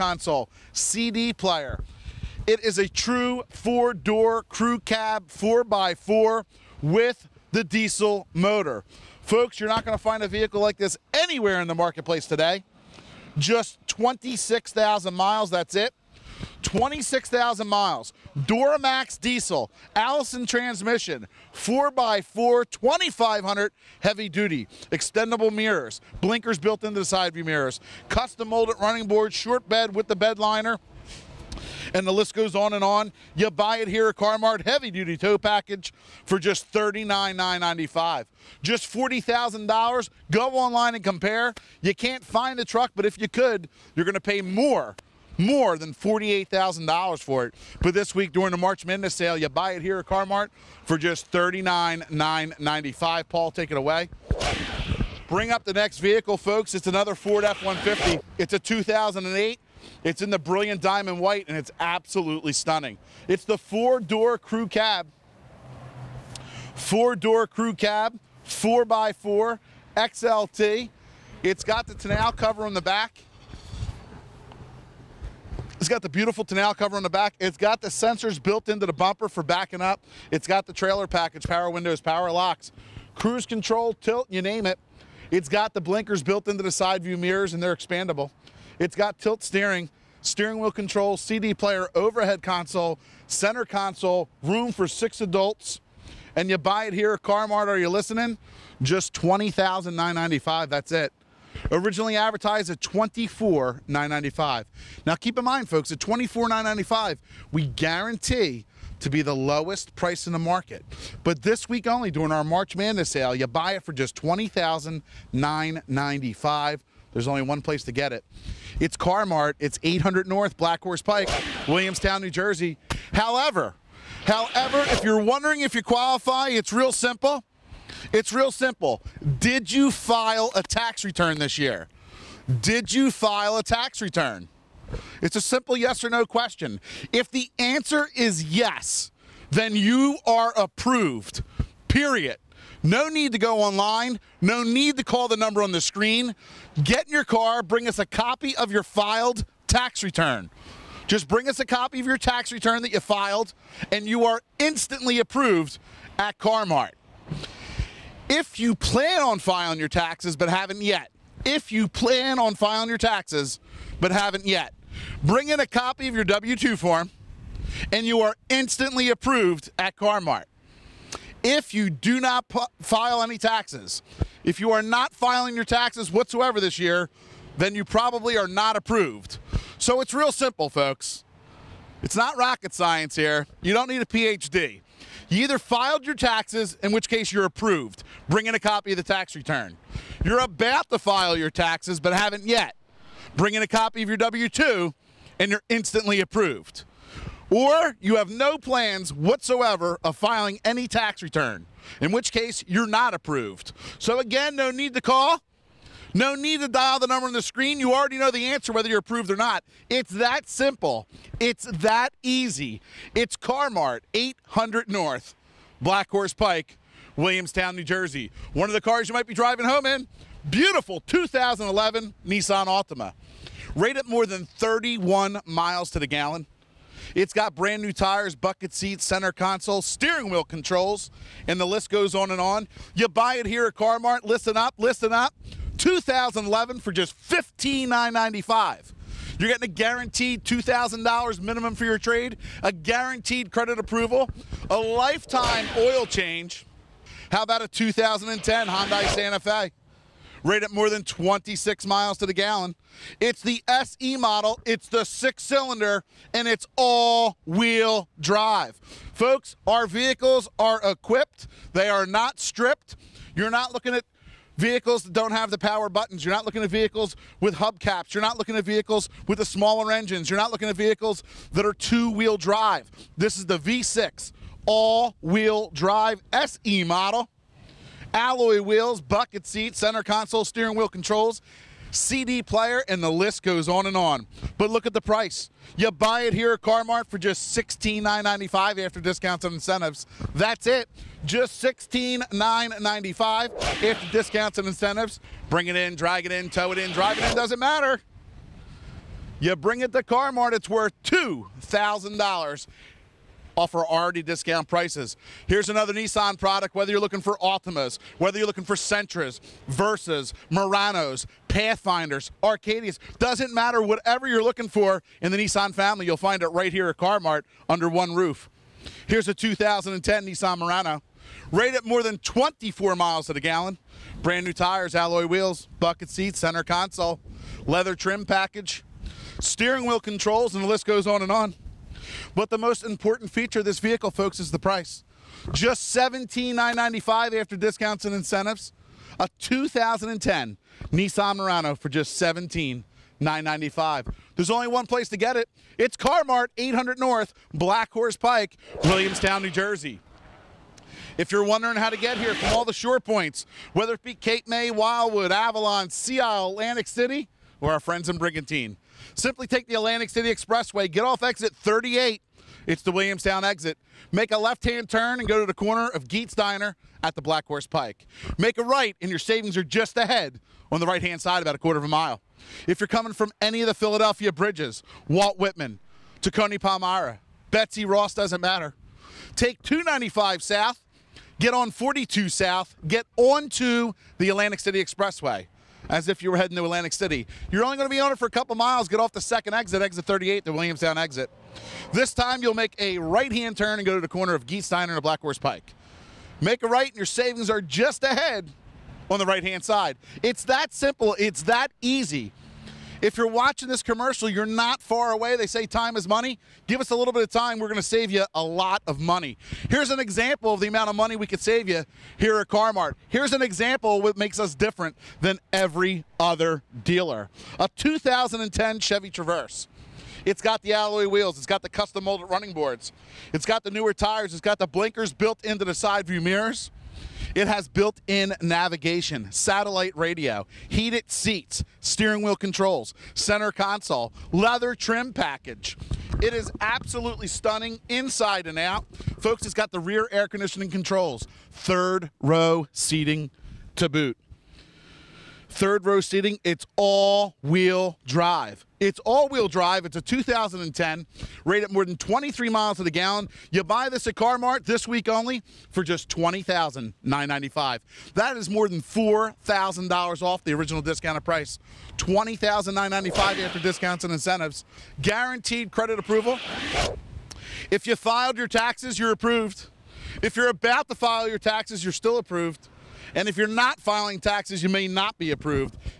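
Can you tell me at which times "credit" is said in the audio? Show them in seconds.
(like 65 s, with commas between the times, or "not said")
243 s, 465 s.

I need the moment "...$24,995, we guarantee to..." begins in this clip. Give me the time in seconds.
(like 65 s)
105 s.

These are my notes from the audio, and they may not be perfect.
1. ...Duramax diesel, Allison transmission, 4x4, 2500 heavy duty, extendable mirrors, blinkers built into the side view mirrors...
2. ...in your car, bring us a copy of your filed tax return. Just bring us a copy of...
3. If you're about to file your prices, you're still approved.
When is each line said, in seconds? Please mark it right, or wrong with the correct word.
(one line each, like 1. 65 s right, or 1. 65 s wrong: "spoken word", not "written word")
1. 18 s right
2. 147 s right
3. 470 s wrong: "taxes", not "prices".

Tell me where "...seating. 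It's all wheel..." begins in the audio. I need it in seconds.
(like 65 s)
445 s.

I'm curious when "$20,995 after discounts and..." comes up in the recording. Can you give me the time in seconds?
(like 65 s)
461 s.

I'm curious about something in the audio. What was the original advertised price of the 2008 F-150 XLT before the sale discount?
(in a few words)
$24,995.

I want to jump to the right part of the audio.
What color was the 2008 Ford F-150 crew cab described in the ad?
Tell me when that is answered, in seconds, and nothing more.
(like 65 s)
60 s.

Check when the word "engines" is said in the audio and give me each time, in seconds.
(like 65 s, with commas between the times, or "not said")
269 s.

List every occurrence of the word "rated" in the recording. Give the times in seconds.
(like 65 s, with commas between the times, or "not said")
223 s, 250 s, 321 s, 451 s.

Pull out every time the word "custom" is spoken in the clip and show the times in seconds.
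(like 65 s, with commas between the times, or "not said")
28 s, 421 s.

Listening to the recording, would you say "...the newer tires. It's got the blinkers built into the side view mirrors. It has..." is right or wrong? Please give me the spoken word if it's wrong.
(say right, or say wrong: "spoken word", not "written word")
right.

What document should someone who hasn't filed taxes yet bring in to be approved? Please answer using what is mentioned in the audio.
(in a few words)
W-2 form.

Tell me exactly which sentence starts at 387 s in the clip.
You're only going to be on it for a couple miles.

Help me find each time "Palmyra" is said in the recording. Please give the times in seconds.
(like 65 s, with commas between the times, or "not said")
376 s.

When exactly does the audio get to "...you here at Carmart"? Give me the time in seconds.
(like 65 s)
411 s.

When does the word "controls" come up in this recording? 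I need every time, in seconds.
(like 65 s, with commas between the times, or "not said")
83 s, 90 s, 230 s, 280 s, 329 s, 432 s, 440 s.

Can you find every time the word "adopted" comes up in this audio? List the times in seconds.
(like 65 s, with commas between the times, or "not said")
not said.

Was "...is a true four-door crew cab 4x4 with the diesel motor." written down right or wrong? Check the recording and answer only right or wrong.
right.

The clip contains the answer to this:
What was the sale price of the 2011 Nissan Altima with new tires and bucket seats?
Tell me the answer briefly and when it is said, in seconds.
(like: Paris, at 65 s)
$15,995, at 237 s.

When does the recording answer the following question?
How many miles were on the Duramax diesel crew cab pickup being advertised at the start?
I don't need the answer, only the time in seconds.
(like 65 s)
13 s.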